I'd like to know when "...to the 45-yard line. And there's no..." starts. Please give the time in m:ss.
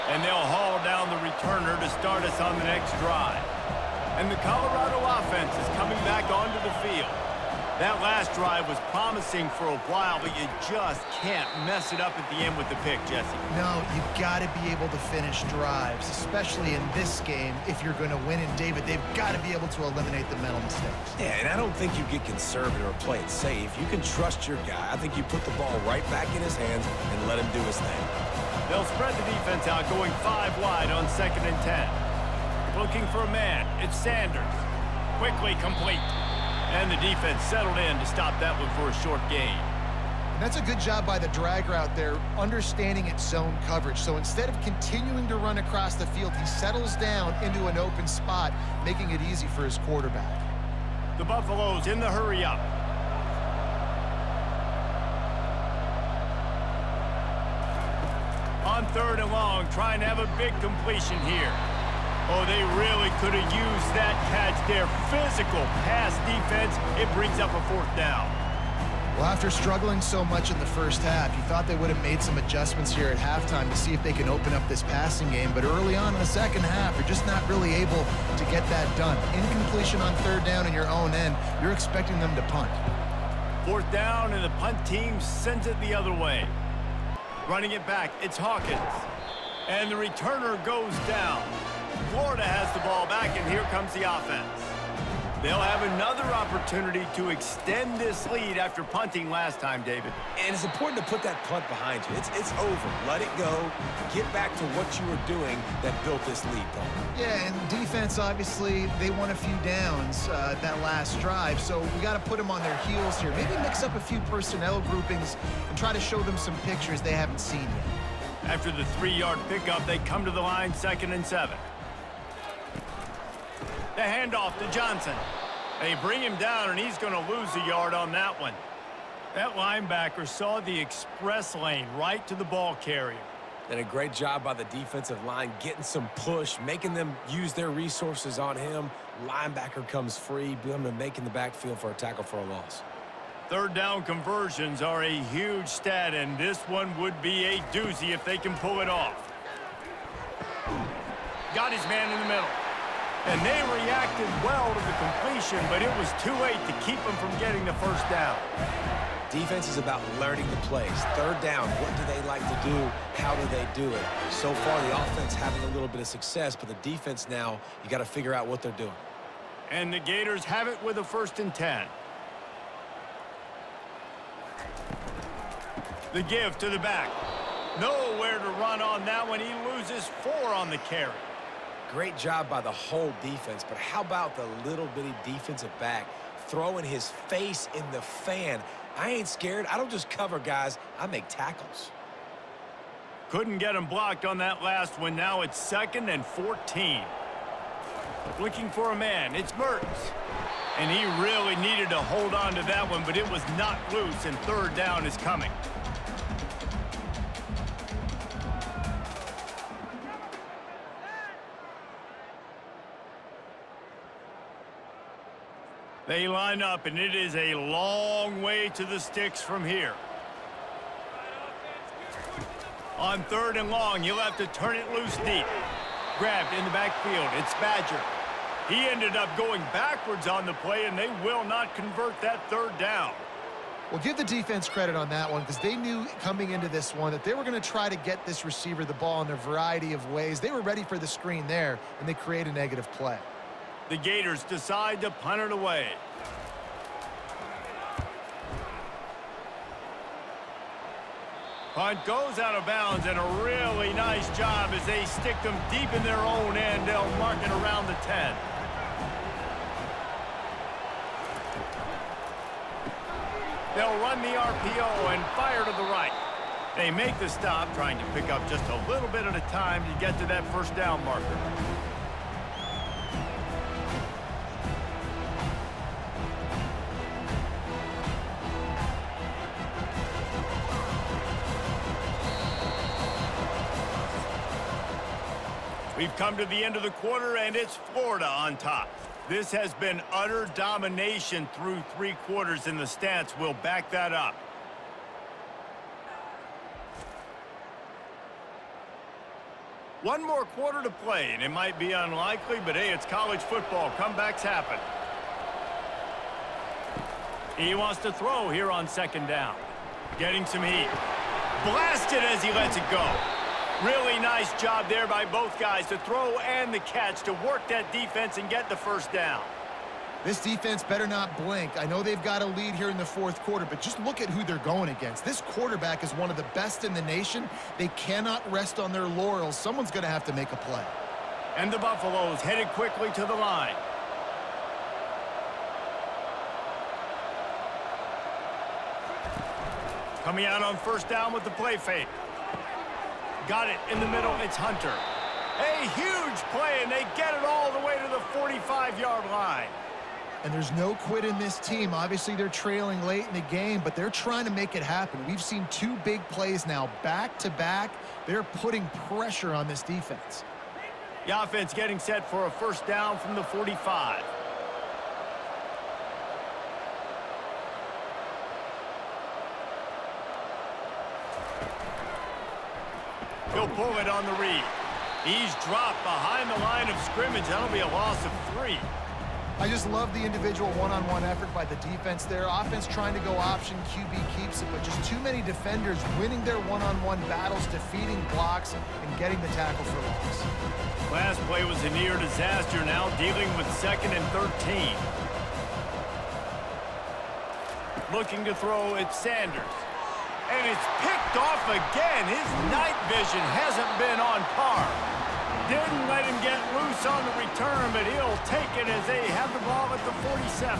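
5:47.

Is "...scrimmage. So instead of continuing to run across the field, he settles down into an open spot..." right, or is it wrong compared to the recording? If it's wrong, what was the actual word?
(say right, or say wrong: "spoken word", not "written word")
wrong: "coverage", not "scrimmage".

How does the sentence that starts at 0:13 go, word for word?
No, you've got to be able to finish drives, especially in this game if you're going to win.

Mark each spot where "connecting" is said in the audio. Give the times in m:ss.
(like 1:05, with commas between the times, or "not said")
not said.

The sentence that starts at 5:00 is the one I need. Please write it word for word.
One more quarter to play, and it might be unlikely, but hey, it's college football.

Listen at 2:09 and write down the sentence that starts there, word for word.
That linebacker saw the express lane right to the ball carrier.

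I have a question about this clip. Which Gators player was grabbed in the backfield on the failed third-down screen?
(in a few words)
Badger.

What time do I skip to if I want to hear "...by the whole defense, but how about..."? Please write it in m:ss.
3:02.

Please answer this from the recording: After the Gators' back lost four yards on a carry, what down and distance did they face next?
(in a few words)
second and 14.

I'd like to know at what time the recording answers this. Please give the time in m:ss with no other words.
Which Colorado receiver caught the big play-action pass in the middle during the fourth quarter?
5:44.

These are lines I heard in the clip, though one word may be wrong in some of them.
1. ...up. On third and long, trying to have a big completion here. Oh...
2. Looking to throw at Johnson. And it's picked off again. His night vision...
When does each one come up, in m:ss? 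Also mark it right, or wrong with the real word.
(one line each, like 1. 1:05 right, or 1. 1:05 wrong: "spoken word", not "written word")
1. 0:52 right
2. 6:38 wrong: "Sanders", not "Johnson".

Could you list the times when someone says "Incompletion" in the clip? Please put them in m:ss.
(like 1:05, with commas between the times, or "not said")
1:19.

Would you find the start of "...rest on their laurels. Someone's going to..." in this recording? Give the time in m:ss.
5:28.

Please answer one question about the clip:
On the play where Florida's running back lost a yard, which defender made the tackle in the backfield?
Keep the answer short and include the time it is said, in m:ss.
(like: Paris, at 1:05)
Billman, at 2:20.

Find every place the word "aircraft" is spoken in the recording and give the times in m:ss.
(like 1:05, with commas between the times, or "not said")
not said.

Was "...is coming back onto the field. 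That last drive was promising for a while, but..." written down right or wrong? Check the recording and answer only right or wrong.
right.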